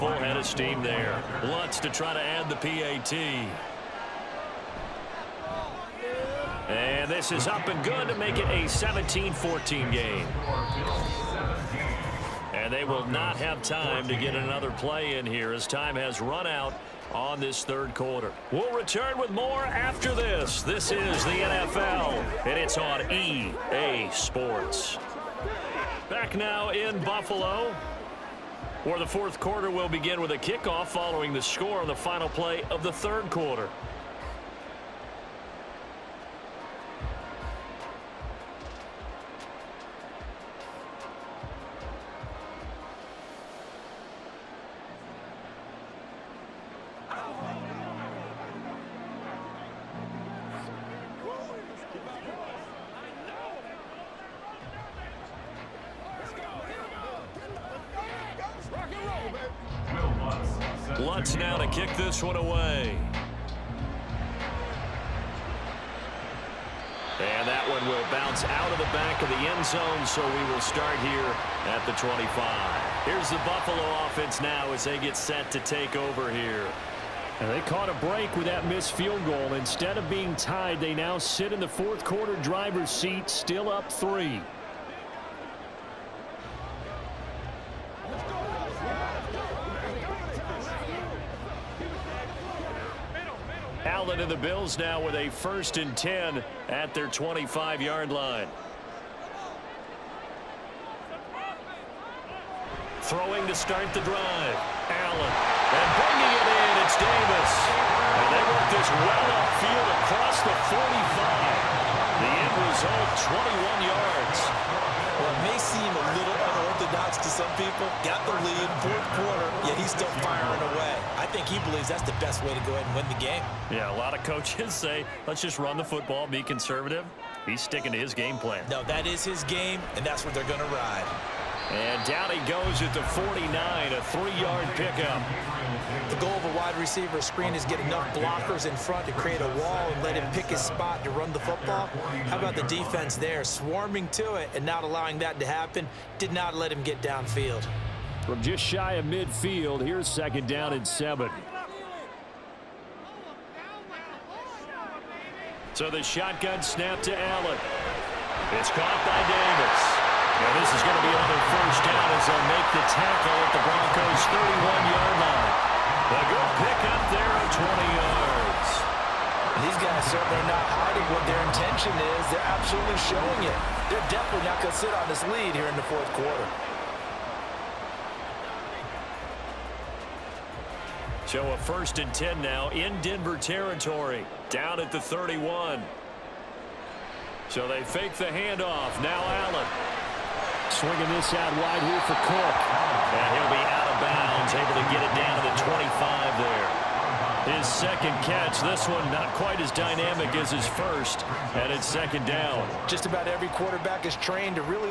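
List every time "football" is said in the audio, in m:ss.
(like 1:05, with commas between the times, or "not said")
2:05, 2:21.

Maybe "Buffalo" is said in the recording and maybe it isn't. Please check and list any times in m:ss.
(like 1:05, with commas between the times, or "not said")
0:27, 1:13.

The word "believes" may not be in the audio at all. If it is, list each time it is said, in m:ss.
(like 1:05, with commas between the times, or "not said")
2:01.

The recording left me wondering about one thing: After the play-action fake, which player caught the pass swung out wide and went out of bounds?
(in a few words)
Cook.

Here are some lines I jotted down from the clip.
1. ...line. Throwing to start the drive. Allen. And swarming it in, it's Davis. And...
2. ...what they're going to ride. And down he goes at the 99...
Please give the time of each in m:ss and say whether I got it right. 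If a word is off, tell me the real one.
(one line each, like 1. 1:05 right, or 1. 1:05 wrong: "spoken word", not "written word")
1. 1:38 wrong: "bringing", not "swarming"
2. 2:10 wrong: "49", not "99".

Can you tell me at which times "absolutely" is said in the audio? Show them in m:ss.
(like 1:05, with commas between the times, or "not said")
2:52.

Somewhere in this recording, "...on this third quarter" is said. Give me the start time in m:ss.
0:17.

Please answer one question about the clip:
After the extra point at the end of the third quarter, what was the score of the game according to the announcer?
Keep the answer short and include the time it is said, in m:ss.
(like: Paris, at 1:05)
17-14, at 0:08.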